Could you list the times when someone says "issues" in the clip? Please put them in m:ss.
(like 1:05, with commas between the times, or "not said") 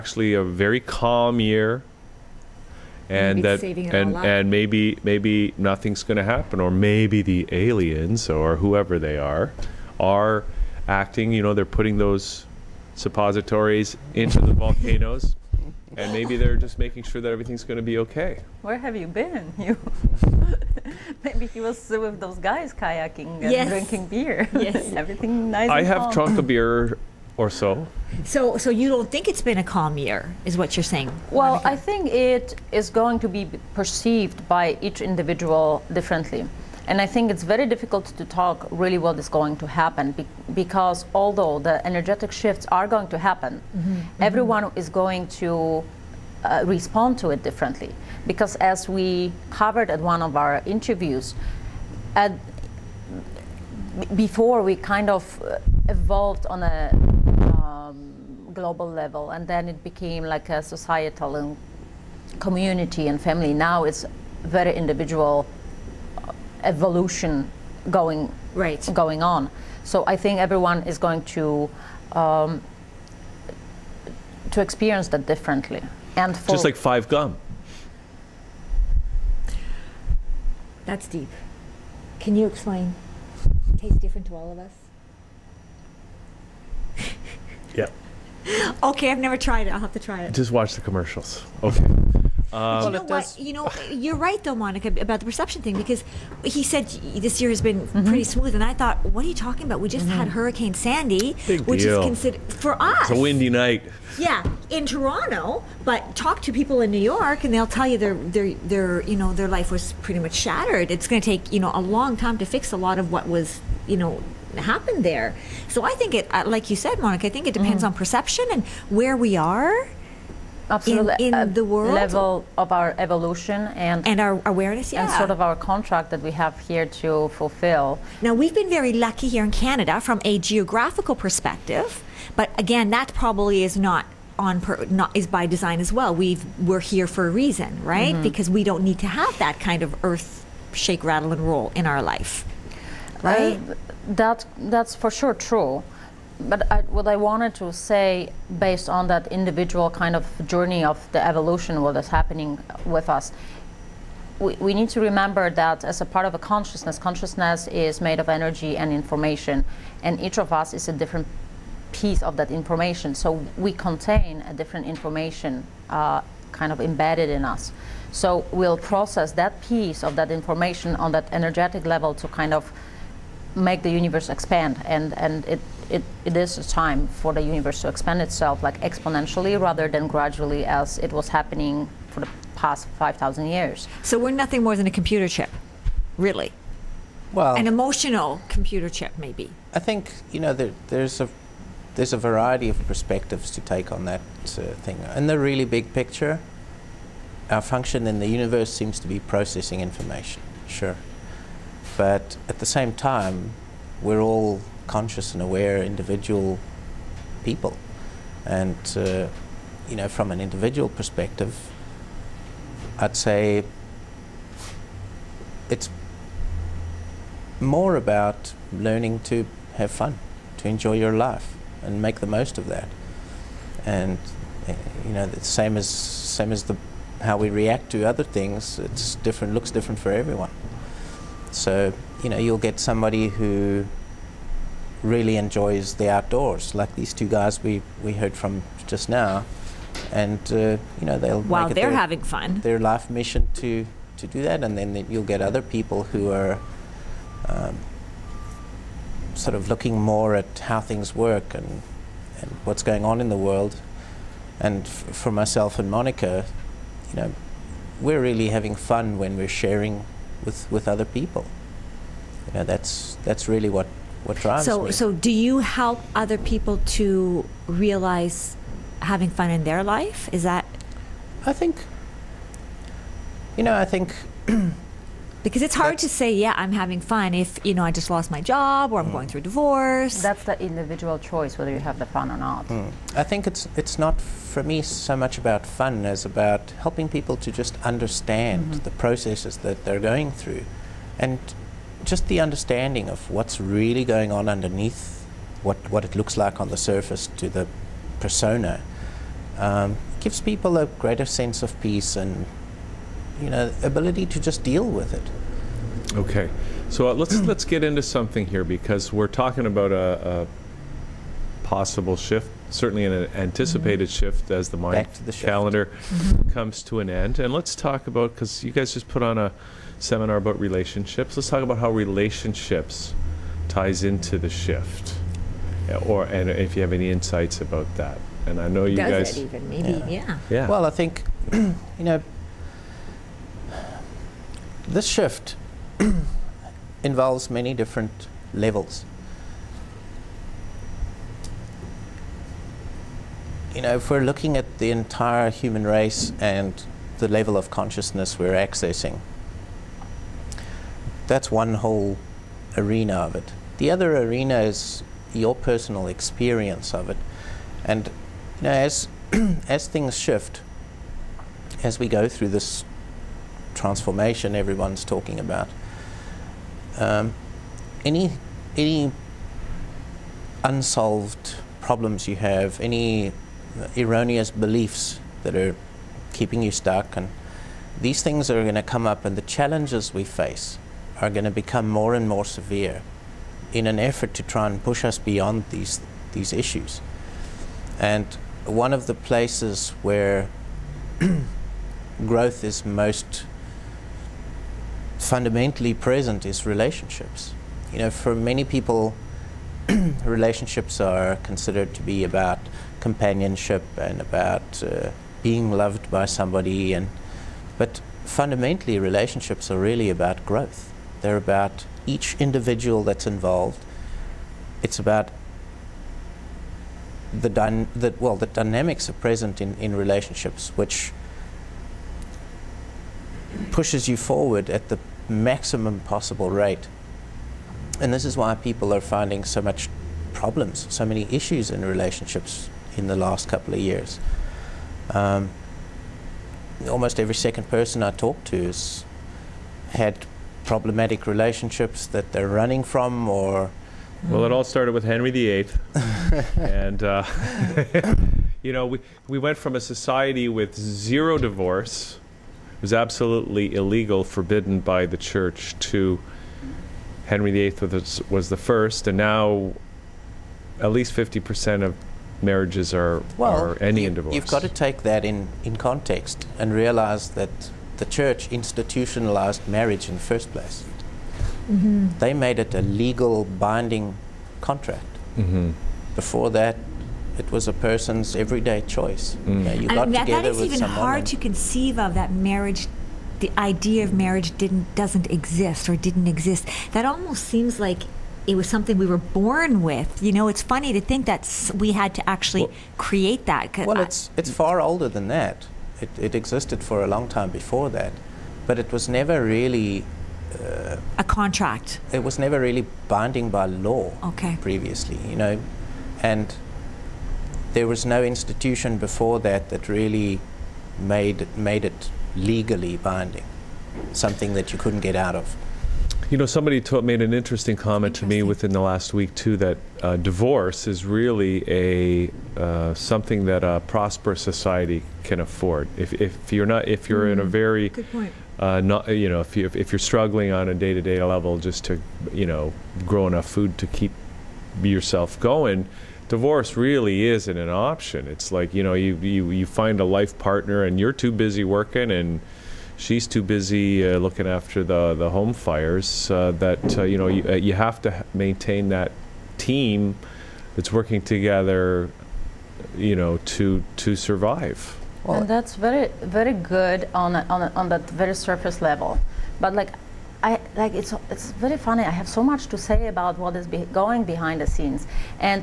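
6:26, 7:11.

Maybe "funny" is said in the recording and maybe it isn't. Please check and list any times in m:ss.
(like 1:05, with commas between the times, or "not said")
8:10, 9:21.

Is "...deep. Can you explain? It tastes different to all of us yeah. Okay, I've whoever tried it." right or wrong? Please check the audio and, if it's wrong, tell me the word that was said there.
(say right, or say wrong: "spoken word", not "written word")
wrong: "never", not "whoever".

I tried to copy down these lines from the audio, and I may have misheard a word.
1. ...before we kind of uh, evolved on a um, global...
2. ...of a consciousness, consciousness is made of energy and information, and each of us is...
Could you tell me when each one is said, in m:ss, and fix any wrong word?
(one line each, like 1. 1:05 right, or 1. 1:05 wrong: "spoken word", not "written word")
1. 0:54 right
2. 2:36 right.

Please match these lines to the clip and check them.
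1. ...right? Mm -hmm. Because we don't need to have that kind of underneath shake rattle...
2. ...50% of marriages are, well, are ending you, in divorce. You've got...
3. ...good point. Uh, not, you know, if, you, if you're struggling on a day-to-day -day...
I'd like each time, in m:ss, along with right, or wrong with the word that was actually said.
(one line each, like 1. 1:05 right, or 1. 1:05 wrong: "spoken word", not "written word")
1. 2:17 wrong: "earth", not "underneath"
2. 7:41 right
3. 8:47 right.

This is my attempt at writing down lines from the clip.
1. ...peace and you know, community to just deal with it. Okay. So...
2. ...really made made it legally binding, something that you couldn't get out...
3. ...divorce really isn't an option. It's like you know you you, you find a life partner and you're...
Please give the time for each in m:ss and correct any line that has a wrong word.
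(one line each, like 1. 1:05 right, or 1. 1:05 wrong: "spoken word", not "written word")
1. 5:01 wrong: "ability", not "community"
2. 8:29 right
3. 8:56 right.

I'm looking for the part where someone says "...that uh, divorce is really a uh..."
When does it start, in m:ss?
8:39.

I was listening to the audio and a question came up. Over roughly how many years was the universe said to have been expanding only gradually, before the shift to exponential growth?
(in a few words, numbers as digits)
5,000 years.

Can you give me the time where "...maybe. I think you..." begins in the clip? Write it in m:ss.
3:09.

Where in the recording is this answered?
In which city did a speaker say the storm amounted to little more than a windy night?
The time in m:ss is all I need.
1:44.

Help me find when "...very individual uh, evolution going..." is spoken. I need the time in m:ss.
1:04.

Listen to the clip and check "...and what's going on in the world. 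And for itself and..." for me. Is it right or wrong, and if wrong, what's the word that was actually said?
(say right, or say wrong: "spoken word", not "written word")
wrong: "myself", not "itself".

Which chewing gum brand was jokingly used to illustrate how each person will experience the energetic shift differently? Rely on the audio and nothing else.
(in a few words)
Five gum.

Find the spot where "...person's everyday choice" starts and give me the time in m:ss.
7:57.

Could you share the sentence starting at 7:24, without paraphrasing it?
Well, it all started with Henry VIII.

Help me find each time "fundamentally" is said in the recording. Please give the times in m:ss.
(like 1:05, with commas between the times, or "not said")
6:35, 6:48.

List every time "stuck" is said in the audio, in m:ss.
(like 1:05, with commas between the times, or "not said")
6:16.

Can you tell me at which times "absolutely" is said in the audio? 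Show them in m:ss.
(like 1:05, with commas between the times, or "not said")
2:00, 7:32.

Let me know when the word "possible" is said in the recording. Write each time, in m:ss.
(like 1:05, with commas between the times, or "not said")
5:11, 7:06.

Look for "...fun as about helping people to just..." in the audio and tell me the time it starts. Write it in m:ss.
4:45.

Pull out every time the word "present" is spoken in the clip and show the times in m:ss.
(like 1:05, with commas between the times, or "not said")
6:35, 6:59.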